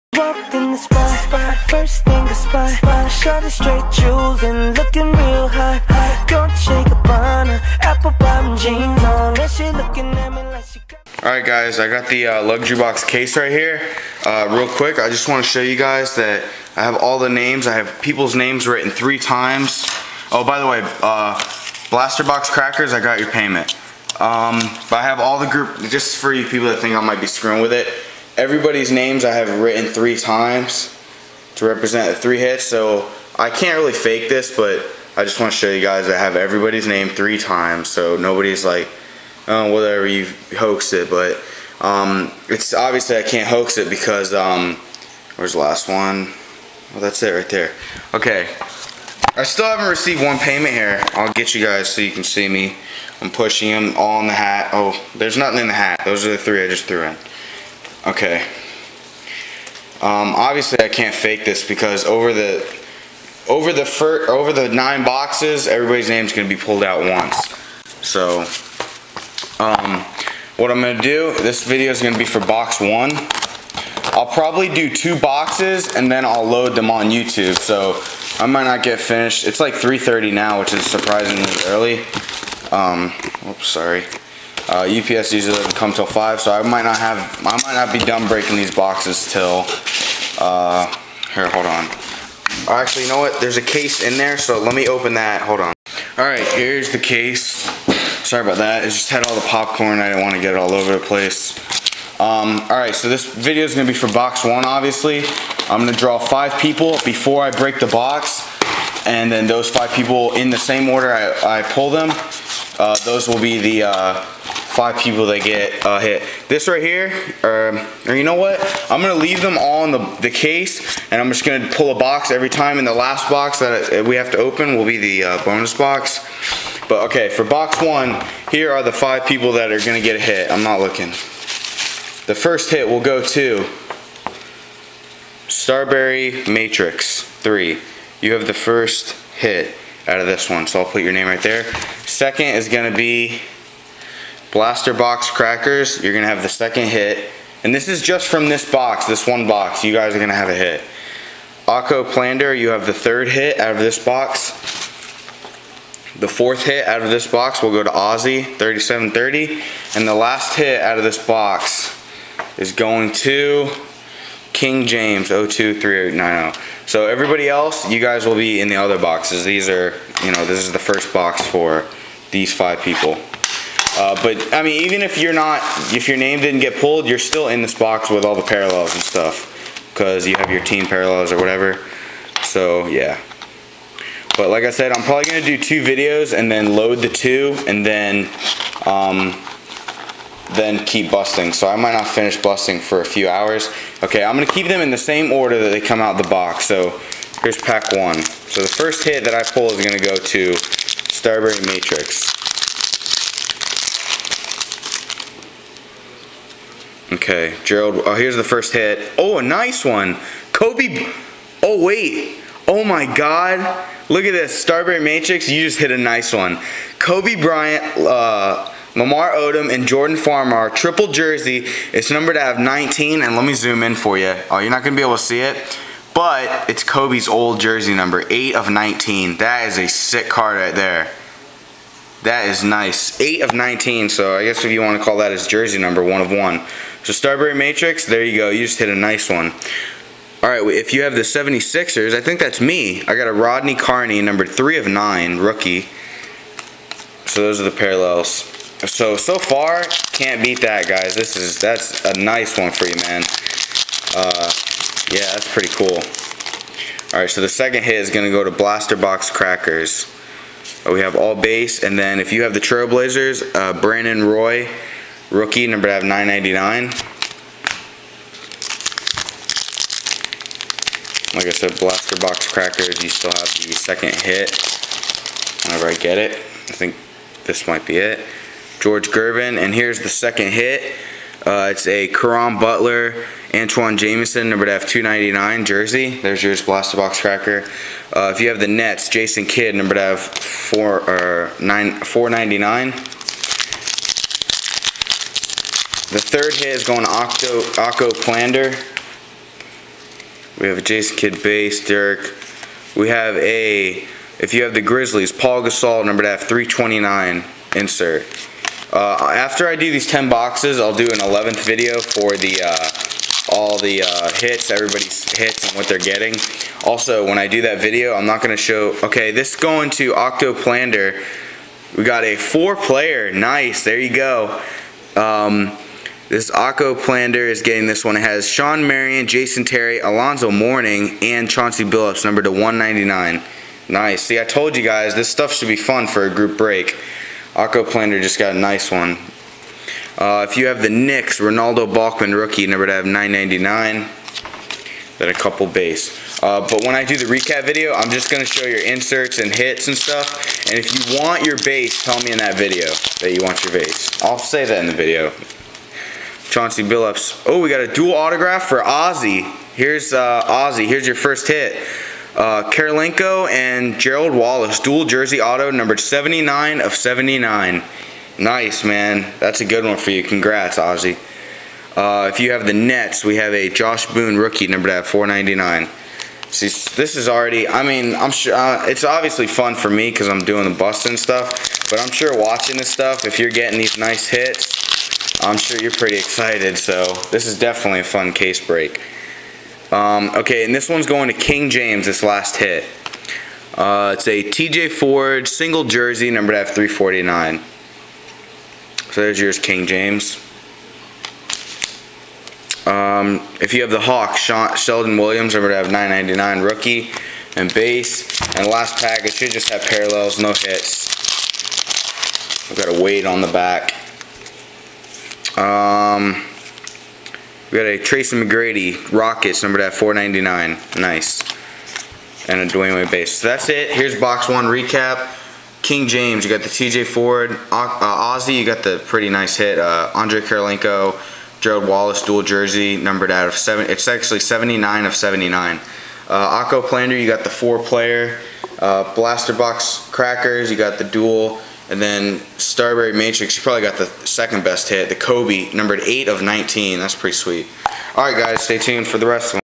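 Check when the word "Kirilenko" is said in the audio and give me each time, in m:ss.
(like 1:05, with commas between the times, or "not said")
6:02, 7:10.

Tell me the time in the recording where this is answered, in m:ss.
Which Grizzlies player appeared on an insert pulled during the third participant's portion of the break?
5:05.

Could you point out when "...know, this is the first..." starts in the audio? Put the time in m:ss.
2:50.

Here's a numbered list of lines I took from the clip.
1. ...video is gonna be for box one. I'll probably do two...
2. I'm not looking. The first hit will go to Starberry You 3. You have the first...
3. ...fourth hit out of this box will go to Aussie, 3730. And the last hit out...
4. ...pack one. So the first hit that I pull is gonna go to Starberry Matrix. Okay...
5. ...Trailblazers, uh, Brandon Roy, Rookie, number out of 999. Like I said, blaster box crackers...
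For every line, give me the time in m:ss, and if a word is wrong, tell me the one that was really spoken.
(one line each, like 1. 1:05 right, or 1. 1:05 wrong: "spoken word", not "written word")
1. 1:11 right
2. 2:10 wrong: "Matrix", not "You"
3. 2:36 right
4. 3:17 right
5. 4:22 right.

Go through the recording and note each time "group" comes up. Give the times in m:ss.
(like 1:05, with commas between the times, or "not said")
0:25, 5:36.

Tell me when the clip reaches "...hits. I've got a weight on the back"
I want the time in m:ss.
6:50.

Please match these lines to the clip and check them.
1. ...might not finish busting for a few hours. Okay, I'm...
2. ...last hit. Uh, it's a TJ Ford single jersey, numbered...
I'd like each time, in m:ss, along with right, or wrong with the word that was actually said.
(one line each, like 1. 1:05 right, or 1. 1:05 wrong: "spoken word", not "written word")
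1. 3:11 right
2. 6:32 right.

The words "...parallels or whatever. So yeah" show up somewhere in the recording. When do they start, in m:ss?
3:00.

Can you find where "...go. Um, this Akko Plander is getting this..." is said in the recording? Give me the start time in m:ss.
5:24.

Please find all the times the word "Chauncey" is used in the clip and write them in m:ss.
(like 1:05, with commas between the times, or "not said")
5:31, 5:56.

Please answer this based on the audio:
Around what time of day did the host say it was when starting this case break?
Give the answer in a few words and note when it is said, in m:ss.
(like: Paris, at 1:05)
3:30, at 1:19.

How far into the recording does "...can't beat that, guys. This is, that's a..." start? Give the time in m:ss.
4:10.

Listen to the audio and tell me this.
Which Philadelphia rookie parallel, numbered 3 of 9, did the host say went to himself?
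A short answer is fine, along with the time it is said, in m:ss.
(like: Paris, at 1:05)
Rodney Carney, at 4:03.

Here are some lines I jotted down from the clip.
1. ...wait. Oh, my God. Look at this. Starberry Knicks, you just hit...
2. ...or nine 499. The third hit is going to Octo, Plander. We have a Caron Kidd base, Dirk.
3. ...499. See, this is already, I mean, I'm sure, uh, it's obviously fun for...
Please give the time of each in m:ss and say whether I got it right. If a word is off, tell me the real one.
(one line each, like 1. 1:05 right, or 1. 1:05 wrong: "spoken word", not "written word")
1. 3:31 wrong: "Matrix", not "Knicks"
2. 4:51 wrong: "Jason", not "Caron"
3. 6:15 right.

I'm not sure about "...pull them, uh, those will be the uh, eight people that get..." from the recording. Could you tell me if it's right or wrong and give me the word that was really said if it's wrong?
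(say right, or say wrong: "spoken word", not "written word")
wrong: "five", not "eight".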